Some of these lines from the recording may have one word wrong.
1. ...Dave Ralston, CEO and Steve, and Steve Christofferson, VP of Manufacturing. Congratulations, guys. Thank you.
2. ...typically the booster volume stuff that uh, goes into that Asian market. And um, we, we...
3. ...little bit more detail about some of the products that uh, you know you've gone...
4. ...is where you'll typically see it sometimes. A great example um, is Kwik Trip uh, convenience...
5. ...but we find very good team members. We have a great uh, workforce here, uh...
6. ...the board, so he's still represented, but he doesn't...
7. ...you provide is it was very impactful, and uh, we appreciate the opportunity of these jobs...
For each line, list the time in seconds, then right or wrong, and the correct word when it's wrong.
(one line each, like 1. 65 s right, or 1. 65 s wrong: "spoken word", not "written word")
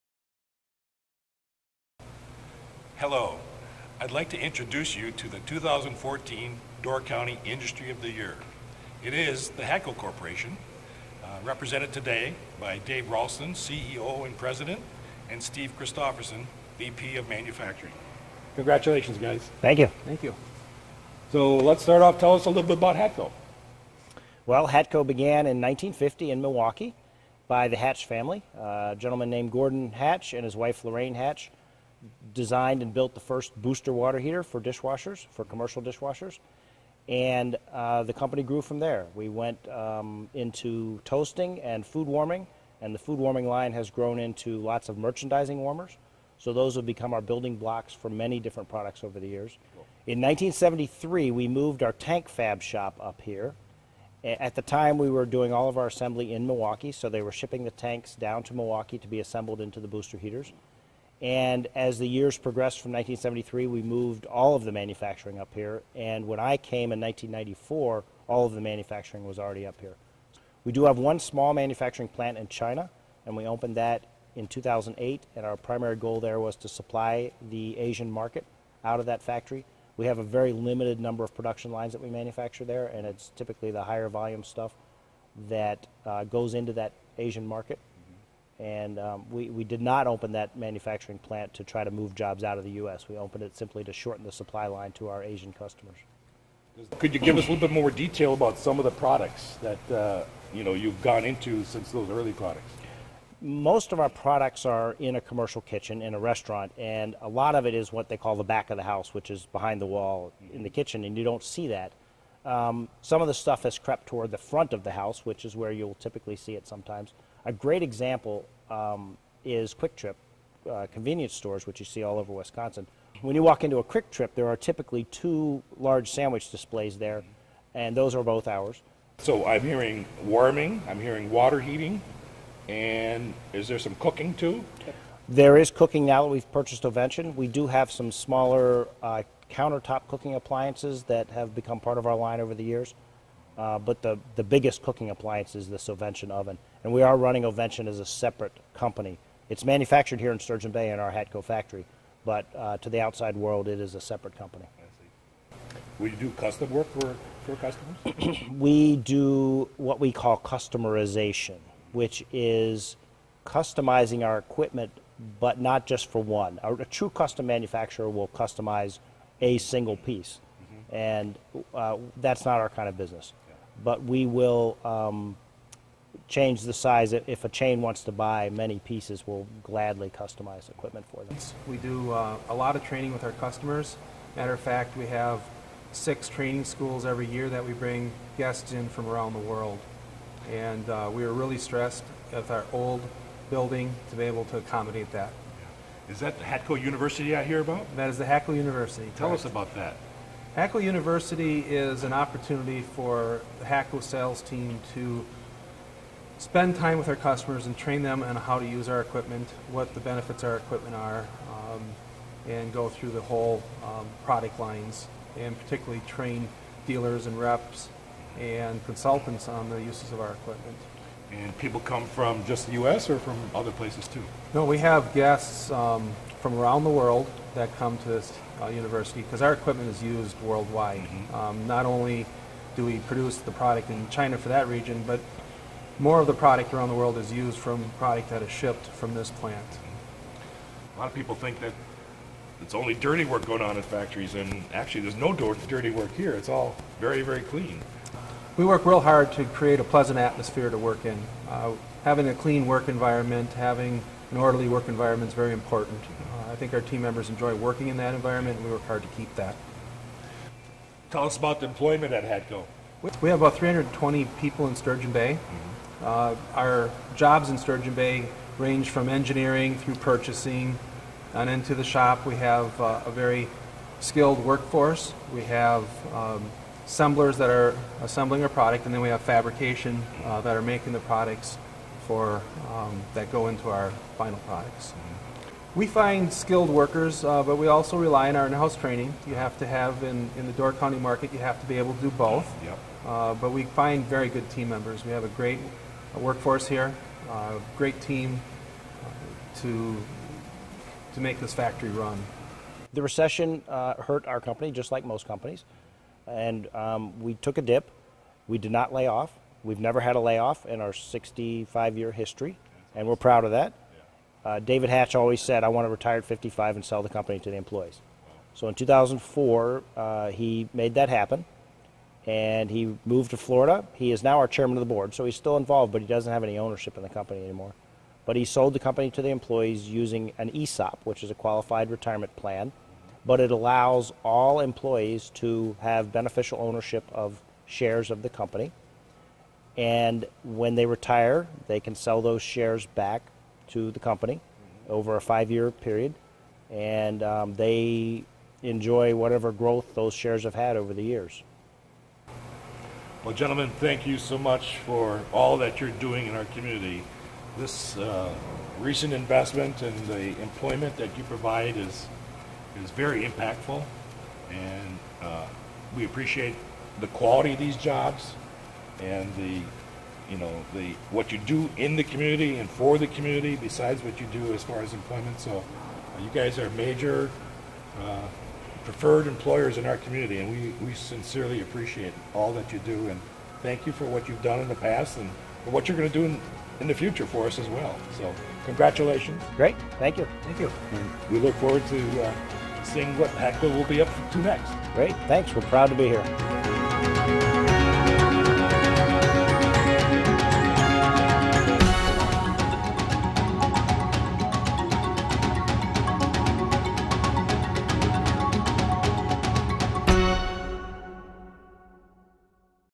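1. 12 s wrong: "President", not "Steve"
2. 83 s wrong: "higher", not "booster"
3. 97 s right
4. 115 s right
5. 293 s right
6. 324 s wrong: "involved", not "represented"
7. 361 s wrong: "quality", not "opportunity".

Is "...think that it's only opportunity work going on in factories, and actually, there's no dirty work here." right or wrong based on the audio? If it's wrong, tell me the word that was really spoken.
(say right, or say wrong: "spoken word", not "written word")
wrong: "dirty", not "opportunity".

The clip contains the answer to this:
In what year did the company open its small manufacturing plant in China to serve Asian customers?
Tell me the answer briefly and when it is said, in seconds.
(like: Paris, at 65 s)
2008, at 74 s.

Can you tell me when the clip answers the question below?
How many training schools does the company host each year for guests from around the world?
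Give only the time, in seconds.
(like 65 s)
185 s.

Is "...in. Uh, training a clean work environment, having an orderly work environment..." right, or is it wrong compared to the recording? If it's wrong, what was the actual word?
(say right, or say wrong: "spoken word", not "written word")
wrong: "having", not "training".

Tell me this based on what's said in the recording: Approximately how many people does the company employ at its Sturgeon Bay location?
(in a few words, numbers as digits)
320.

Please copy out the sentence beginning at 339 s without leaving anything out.
And when they retire, they can sell those shares back to the company over a five year period.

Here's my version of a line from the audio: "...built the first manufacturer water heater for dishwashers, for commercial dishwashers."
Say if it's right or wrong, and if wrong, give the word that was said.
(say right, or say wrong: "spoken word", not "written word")
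wrong: "booster", not "manufacturer".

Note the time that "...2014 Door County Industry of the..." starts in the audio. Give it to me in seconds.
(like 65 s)
5 s.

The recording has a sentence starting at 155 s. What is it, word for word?
We do custom work for, for customers?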